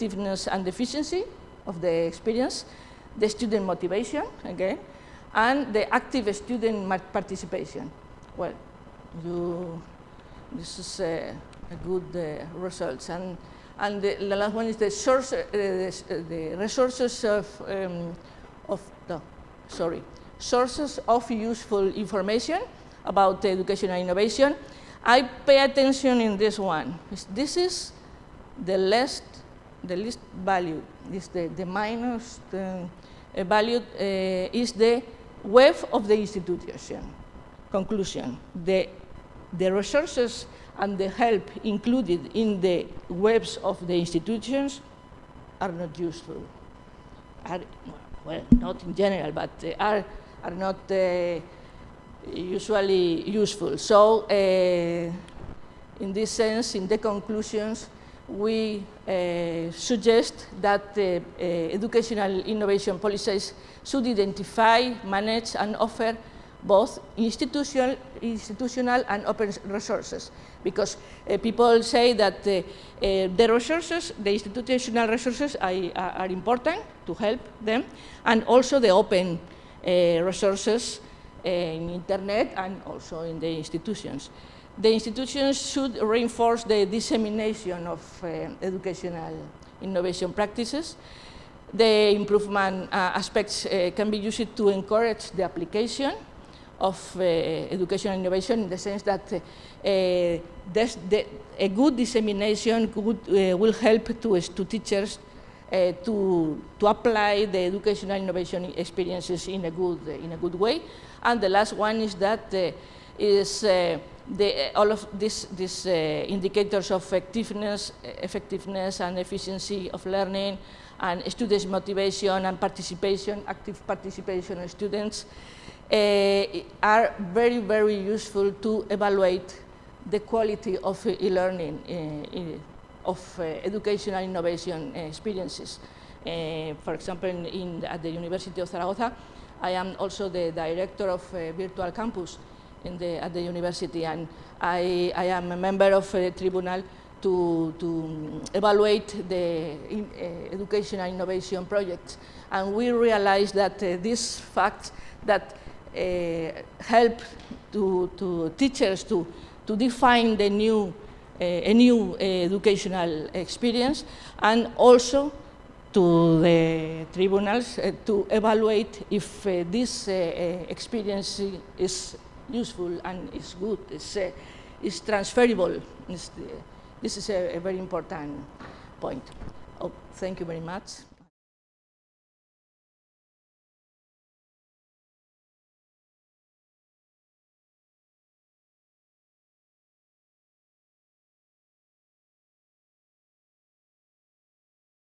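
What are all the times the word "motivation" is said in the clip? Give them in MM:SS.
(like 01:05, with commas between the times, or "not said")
00:03, 02:01.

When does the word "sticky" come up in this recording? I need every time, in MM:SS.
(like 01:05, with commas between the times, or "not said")
not said.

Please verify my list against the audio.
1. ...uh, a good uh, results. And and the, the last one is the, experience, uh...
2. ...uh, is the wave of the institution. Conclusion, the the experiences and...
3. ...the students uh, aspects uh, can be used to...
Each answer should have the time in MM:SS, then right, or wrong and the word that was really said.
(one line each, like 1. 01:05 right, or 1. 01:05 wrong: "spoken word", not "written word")
1. 00:11 wrong: "source", not "experience"
2. 00:33 wrong: "resources", not "experiences"
3. 01:31 wrong: "improvement", not "students".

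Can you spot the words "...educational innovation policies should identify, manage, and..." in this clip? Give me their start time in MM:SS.
01:01.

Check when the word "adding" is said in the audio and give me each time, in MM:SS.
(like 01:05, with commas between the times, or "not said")
not said.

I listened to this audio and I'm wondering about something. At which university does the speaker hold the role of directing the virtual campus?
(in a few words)
University of Zaragoza.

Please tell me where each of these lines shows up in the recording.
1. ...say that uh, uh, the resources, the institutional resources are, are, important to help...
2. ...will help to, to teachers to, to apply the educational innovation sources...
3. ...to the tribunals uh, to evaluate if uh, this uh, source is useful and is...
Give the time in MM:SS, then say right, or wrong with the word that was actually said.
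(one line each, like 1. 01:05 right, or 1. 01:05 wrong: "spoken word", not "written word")
1. 01:11 right
2. 01:43 wrong: "experiences", not "sources"
3. 02:45 wrong: "experience", not "source".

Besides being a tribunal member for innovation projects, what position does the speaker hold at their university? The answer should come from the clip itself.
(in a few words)
Director of Virtual Campus.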